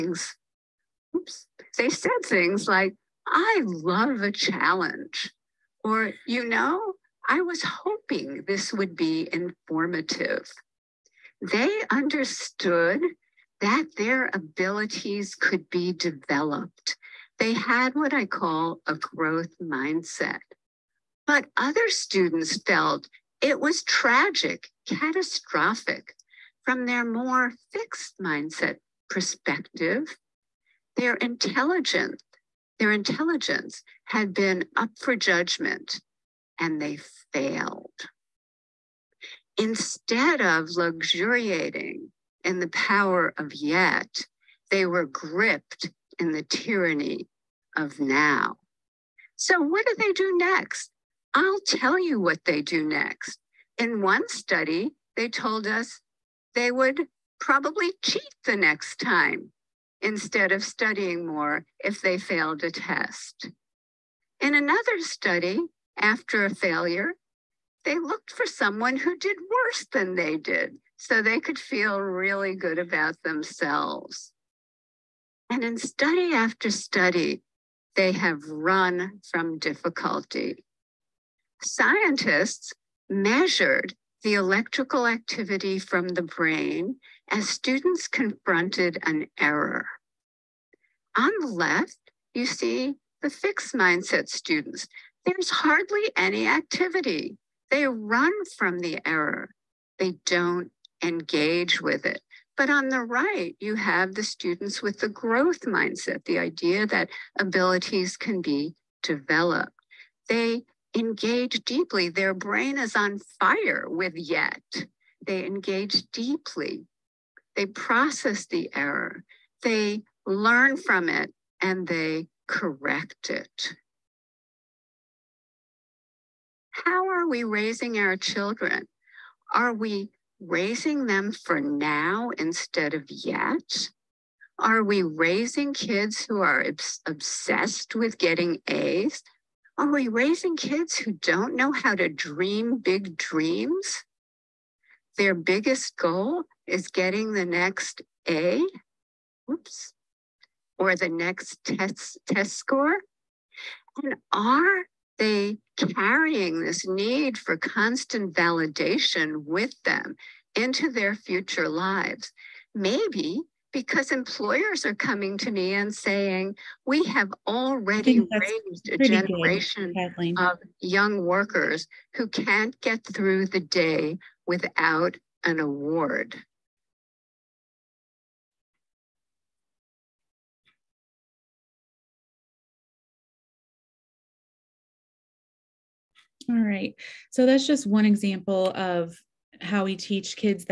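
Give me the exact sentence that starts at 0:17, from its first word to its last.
They had what I call a growth mindset.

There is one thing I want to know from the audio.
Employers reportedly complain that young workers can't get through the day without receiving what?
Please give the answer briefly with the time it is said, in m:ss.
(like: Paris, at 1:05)
An award, at 2:55.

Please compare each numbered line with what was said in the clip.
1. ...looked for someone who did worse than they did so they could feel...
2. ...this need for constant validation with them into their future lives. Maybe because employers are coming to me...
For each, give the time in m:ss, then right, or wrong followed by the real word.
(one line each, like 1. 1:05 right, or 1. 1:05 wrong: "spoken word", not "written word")
1. 1:07 right
2. 2:36 right.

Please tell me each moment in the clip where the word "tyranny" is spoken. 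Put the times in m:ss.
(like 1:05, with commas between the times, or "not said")
0:46.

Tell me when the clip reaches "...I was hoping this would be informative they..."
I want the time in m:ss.
0:07.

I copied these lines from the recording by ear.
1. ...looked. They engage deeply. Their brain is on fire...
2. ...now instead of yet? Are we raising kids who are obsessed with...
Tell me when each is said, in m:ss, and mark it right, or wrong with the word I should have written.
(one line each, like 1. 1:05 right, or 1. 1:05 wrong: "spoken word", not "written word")
1. 1:49 wrong: "developed", not "looked"
2. 2:11 right.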